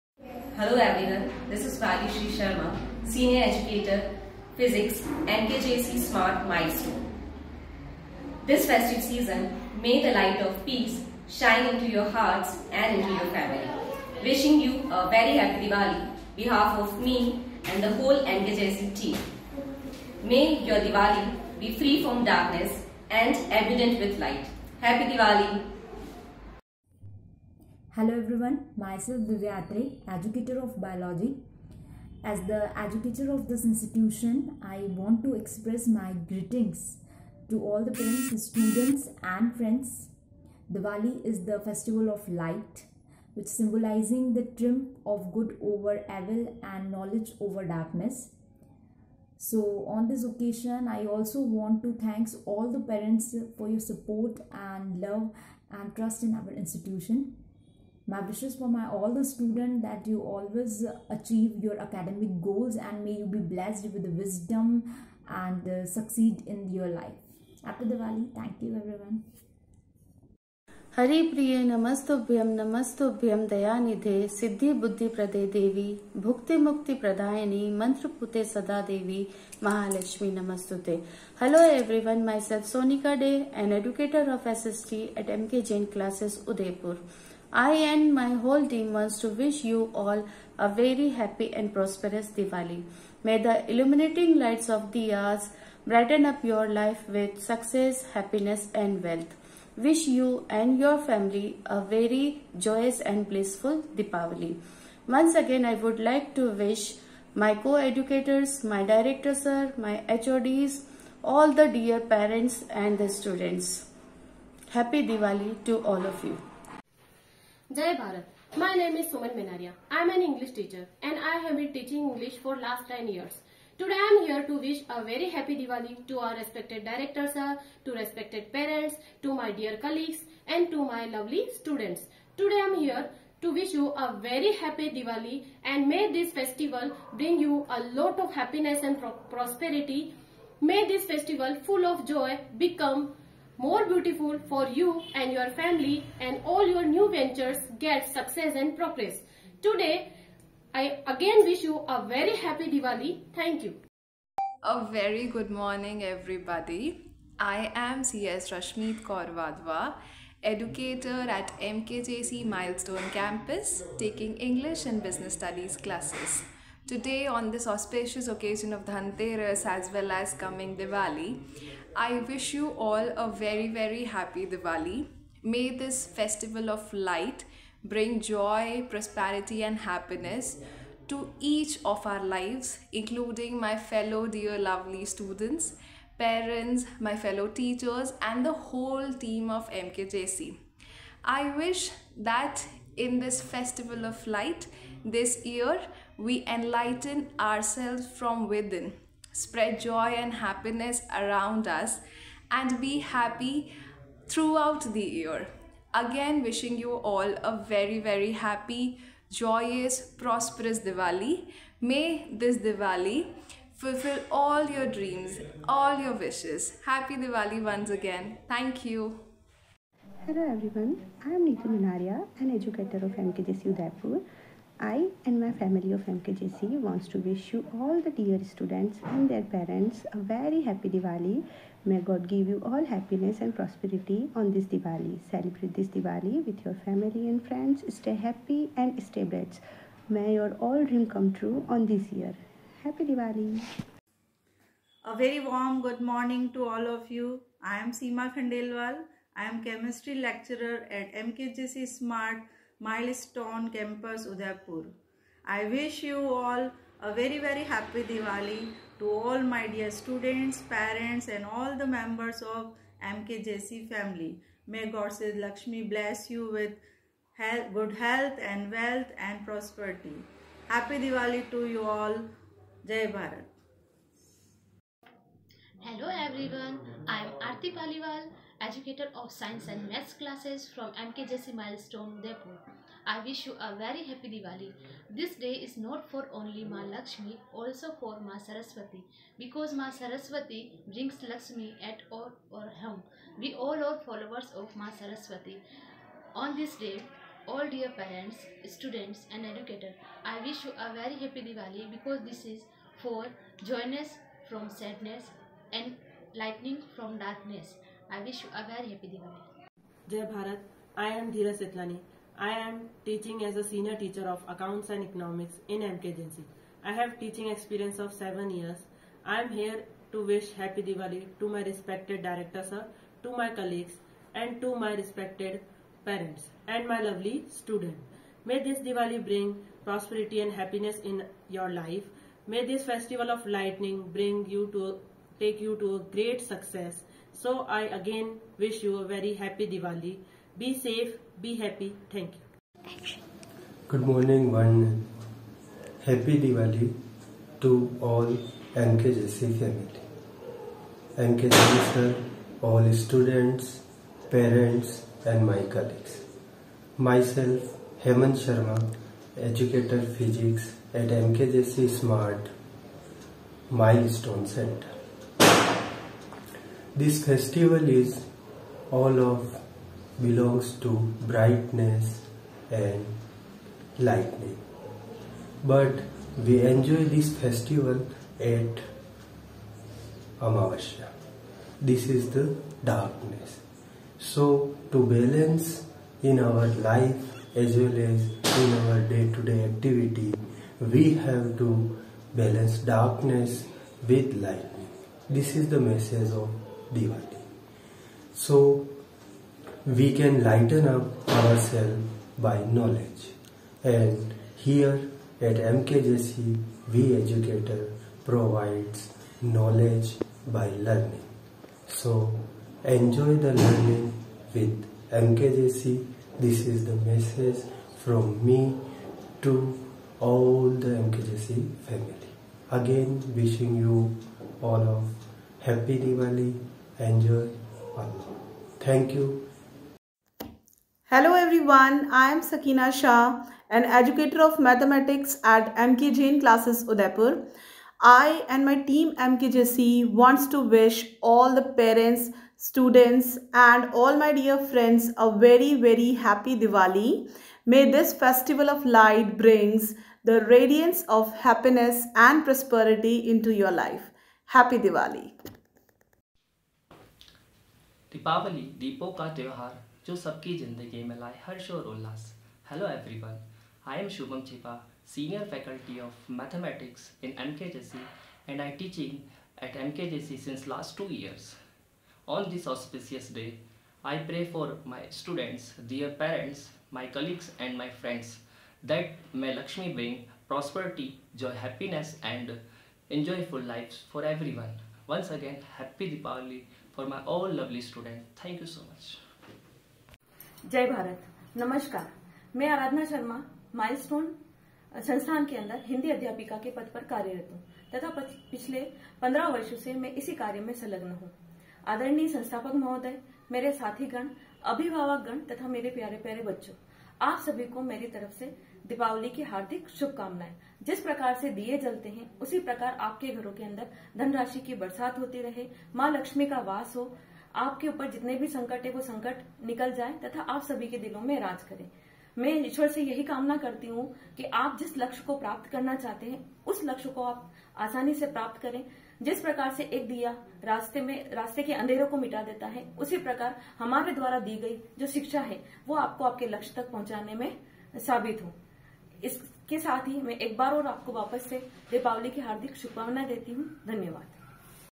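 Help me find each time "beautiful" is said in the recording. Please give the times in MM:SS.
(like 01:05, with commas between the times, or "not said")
02:23.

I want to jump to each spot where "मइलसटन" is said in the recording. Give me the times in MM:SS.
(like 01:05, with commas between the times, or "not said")
08:13.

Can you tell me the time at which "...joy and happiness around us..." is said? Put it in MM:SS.
03:19.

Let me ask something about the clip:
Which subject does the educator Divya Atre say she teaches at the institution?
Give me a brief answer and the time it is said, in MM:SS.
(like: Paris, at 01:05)
biology, at 00:30.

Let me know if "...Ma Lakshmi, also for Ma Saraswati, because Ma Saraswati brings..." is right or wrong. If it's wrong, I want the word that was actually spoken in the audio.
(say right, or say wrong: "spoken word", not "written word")
right.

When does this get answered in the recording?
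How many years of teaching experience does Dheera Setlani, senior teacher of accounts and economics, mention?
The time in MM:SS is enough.
05:18.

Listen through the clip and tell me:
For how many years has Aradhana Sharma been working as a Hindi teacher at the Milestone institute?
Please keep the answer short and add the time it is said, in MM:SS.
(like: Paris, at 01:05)
15, at 08:19.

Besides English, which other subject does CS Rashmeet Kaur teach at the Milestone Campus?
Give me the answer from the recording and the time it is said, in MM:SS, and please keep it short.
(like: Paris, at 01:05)
Business Studies, at 02:45.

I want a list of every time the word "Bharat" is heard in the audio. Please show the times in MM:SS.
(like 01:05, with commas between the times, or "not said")
01:57, 04:33, 05:10.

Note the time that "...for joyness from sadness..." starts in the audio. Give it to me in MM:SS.
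05:03.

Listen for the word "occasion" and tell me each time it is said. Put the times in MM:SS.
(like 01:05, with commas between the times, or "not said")
00:50, 02:48.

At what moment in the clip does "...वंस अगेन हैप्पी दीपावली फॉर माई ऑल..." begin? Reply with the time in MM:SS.
08:05.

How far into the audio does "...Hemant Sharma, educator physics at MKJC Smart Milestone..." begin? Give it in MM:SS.
05:58.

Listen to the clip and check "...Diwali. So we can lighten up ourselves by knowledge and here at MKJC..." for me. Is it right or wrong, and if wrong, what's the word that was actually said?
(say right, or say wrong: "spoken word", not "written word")
right.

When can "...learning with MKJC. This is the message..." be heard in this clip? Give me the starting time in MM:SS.
06:53.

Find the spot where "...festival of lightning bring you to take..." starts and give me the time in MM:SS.
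05:32.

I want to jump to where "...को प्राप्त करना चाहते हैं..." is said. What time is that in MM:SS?
08:45.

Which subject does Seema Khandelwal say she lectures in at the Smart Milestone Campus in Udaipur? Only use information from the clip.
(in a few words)
chemistry.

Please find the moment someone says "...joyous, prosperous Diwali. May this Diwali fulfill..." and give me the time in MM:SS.
03:29.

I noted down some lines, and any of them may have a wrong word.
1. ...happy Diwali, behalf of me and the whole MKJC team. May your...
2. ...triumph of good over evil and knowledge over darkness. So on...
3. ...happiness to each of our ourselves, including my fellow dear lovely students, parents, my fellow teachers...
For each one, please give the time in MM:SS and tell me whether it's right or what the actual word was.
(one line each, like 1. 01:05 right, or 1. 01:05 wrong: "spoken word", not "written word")
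1. 00:15 right
2. 00:44 right
3. 02:59 wrong: "lives", not "ourselves".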